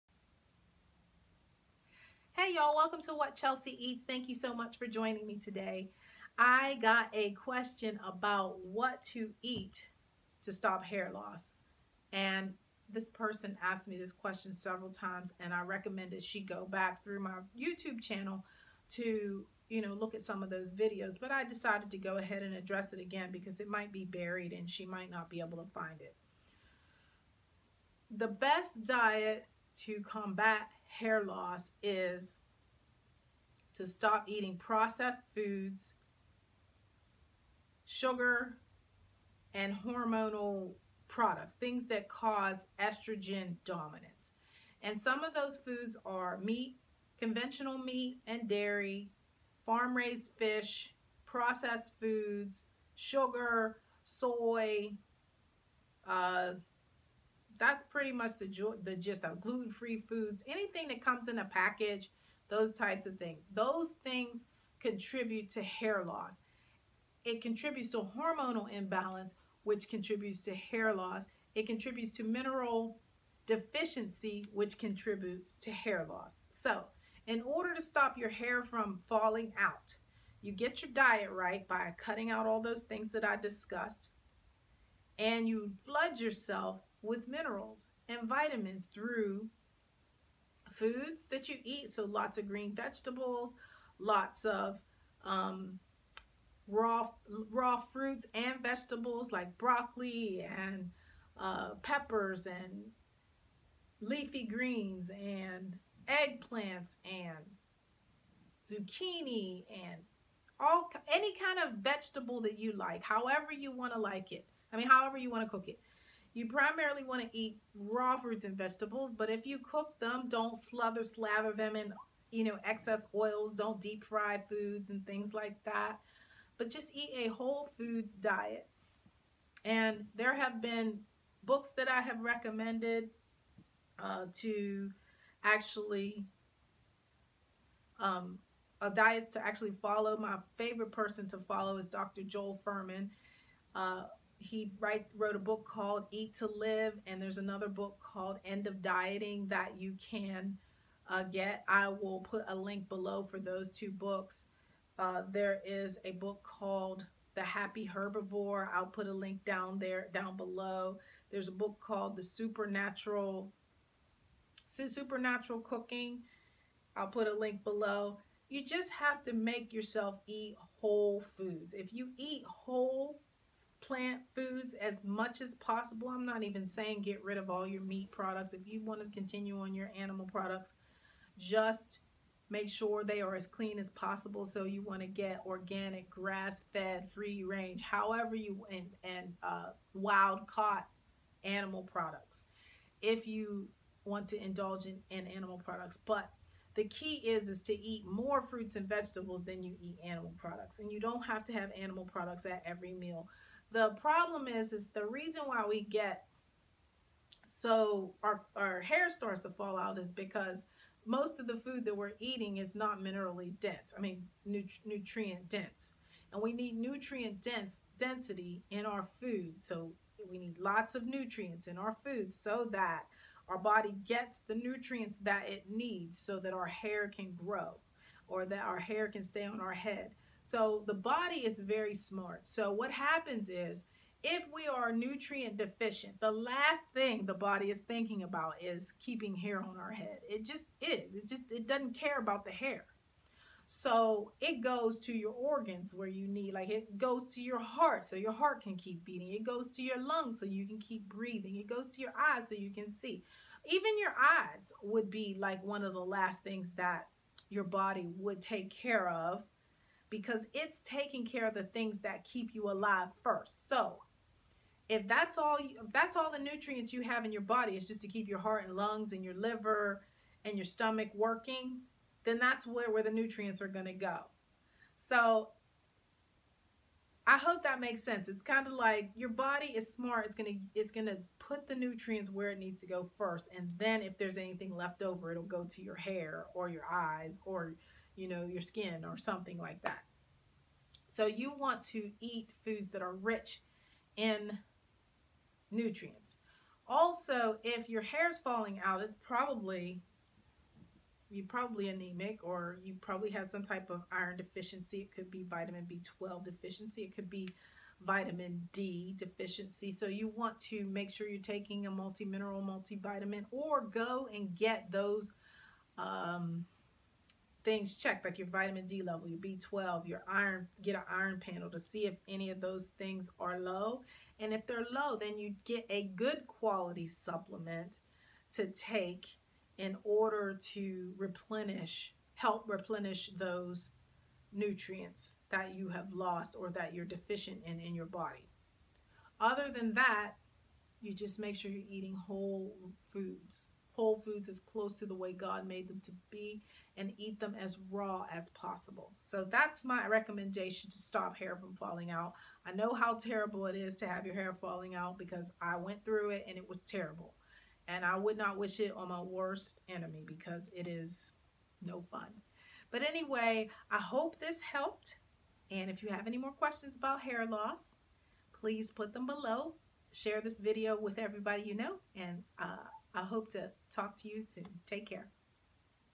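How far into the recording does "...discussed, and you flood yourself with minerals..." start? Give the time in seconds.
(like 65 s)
83 s.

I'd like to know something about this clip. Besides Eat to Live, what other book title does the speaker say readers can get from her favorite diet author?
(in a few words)
End of Dieting.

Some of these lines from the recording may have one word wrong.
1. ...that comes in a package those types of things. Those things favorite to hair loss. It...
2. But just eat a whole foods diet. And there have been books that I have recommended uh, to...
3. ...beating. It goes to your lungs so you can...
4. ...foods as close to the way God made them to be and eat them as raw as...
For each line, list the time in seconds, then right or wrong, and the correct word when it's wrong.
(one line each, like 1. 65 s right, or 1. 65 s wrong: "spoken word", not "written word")
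1. 60 s wrong: "contribute", not "favorite"
2. 126 s right
3. 249 s right
4. 344 s right.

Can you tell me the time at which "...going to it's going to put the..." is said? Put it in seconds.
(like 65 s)
280 s.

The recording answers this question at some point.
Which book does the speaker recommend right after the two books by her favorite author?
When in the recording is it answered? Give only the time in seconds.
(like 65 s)
157 s.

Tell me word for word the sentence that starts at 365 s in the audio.
And if you have any more questions about hair loss, please put them below.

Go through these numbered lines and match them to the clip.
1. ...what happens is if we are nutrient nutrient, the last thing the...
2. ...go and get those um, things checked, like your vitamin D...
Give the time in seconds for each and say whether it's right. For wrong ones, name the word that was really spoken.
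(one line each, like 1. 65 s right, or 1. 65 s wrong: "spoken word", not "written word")
1. 232 s wrong: "deficient", not "nutrient"
2. 313 s right.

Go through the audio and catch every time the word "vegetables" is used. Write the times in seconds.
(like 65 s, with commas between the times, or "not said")
92 s, 98 s, 111 s, 118 s, 198 s.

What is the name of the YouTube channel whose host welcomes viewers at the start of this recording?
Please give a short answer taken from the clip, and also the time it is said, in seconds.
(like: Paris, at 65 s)
What Chelsea Eats, at 3 s.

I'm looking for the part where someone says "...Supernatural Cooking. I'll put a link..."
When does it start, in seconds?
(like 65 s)
164 s.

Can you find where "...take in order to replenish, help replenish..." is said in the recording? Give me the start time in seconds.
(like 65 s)
328 s.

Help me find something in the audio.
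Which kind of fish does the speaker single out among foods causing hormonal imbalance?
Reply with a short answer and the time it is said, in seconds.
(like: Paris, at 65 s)
Farm raised fish, at 49 s.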